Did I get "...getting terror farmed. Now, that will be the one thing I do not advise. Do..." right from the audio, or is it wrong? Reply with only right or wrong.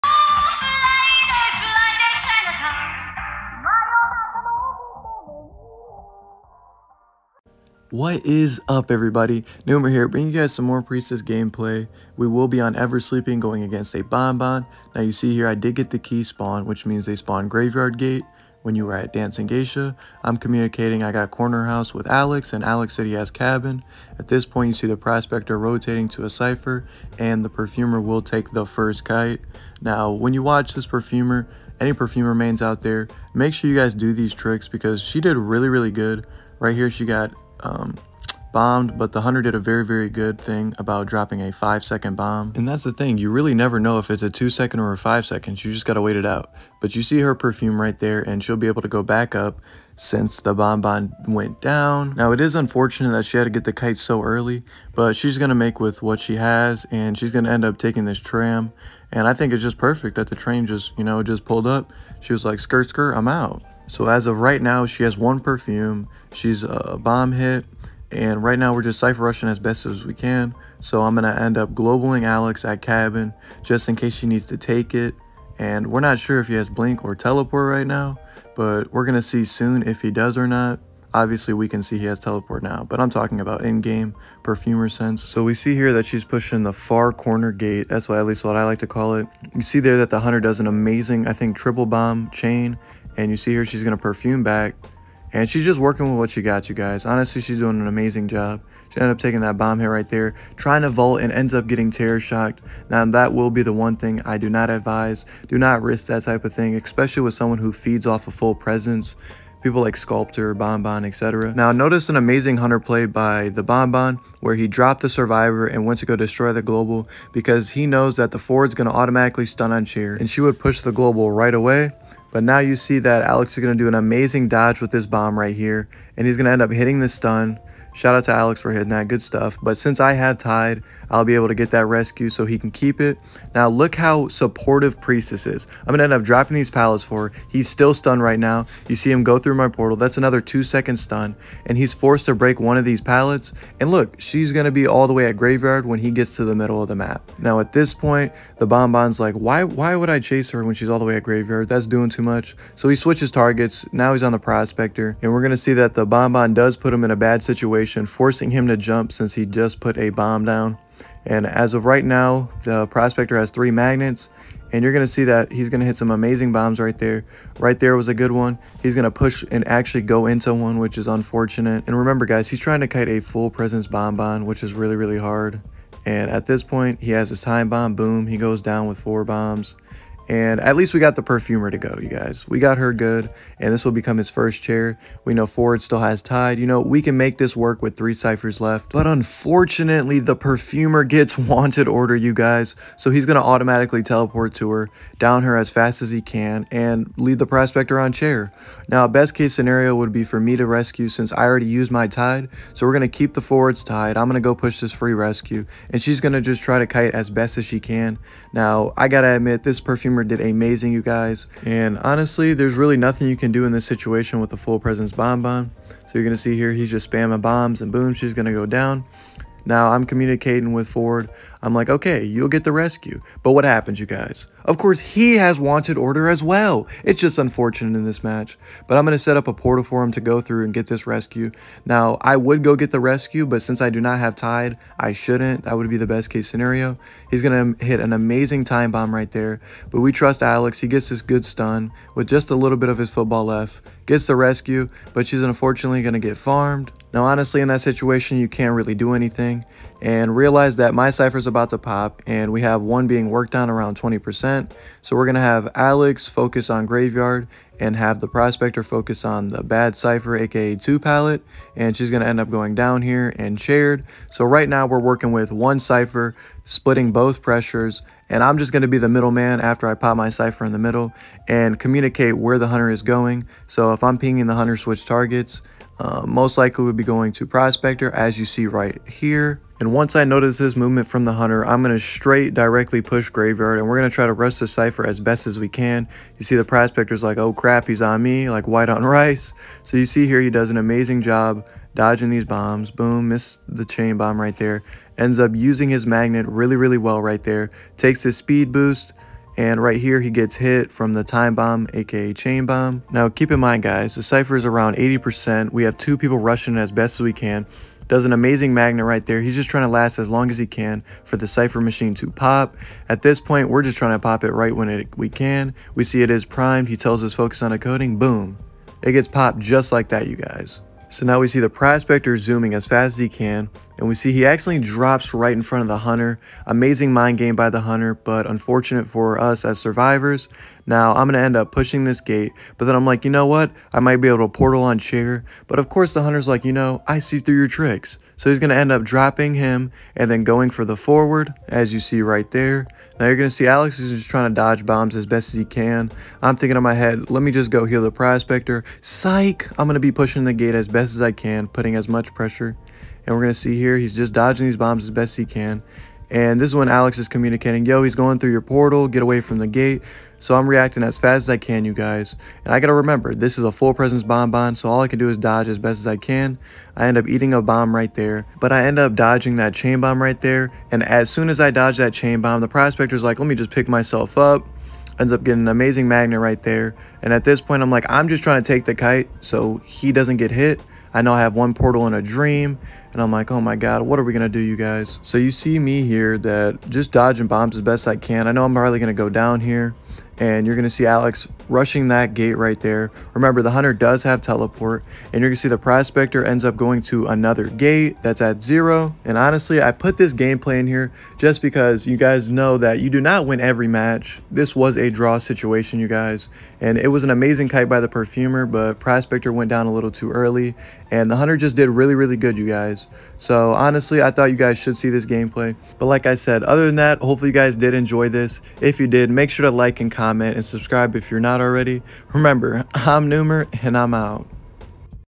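wrong.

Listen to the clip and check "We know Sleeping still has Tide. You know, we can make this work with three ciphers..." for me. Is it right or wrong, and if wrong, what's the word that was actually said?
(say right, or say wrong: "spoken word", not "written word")
wrong: "Ford", not "Sleeping".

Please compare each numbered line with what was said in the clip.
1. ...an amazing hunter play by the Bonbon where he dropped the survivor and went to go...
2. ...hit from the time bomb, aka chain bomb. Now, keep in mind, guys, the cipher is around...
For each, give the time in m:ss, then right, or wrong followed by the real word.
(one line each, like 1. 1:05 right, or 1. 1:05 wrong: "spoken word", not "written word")
1. 1:52 right
2. 5:00 right.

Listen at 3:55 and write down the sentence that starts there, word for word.
That would be the best case scenario.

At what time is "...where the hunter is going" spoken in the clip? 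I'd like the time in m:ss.
4:32.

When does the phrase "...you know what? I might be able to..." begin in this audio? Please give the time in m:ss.
5:33.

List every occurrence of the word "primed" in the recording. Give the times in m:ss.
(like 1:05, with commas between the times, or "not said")
5:16.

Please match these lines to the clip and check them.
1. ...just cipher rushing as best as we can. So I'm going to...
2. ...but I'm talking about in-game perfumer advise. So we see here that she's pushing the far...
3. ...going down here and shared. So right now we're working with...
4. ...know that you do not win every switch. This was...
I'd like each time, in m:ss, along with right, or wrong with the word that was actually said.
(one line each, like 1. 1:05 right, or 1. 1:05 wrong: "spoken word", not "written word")
1. 1:08 right
2. 1:22 wrong: "sense", not "advise"
3. 4:22 right
4. 6:42 wrong: "match", not "switch".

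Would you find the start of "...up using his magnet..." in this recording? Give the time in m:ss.
4:55.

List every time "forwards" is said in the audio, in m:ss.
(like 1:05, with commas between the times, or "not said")
3:23, 5:40.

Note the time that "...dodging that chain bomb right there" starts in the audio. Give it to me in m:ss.
6:09.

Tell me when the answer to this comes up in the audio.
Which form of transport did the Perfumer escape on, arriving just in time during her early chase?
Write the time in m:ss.
0:58.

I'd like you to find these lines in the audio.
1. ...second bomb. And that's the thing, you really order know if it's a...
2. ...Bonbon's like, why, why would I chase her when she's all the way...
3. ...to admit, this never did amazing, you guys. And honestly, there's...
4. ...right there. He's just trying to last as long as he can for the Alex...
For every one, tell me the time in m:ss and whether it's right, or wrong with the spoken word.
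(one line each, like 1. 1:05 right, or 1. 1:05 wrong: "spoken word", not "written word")
1. 0:41 wrong: "never", not "order"
2. 2:28 right
3. 3:29 wrong: "perfumer", not "never"
4. 5:09 wrong: "Cypher", not "Alex".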